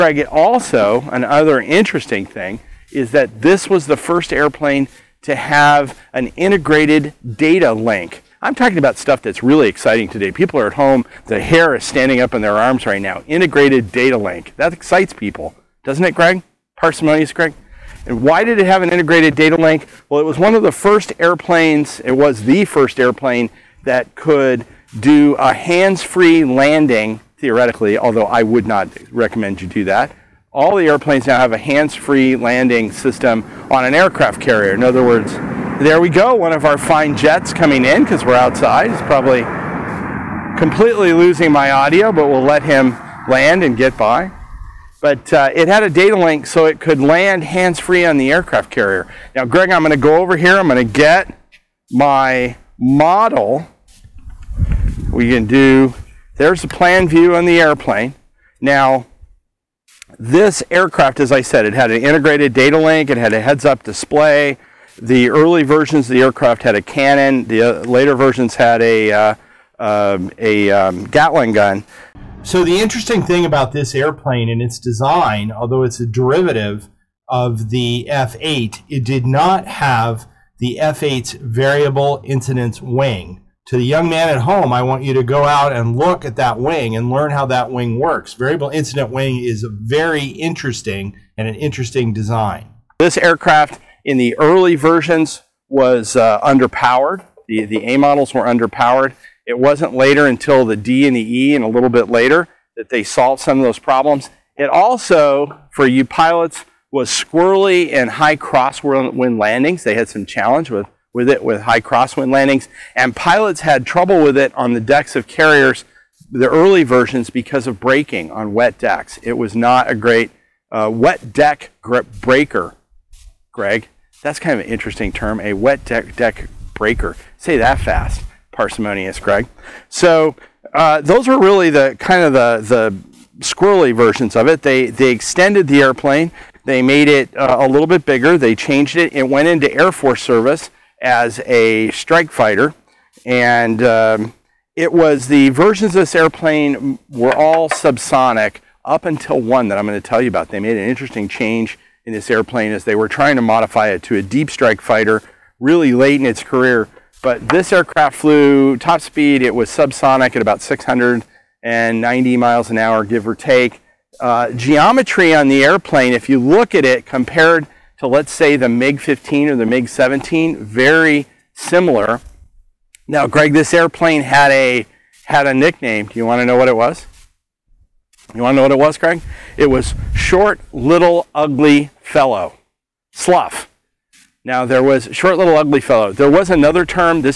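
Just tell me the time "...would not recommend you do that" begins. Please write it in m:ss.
0:28.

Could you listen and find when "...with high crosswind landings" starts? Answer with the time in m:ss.
1:51.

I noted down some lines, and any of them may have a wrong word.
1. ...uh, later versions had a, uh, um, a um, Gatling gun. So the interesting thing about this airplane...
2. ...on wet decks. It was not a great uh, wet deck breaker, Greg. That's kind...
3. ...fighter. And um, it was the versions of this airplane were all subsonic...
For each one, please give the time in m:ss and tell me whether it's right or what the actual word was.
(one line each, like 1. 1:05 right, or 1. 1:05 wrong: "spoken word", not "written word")
1. 1:07 right
2. 1:58 right
3. 2:22 right.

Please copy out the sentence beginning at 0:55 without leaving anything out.
We can do, there's the plan view on the airplane.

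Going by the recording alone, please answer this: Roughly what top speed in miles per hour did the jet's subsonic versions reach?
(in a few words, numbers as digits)
690 mph.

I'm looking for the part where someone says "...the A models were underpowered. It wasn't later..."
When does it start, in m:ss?
1:37.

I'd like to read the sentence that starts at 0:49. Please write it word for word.
Now, Greg, I'm going to go over here.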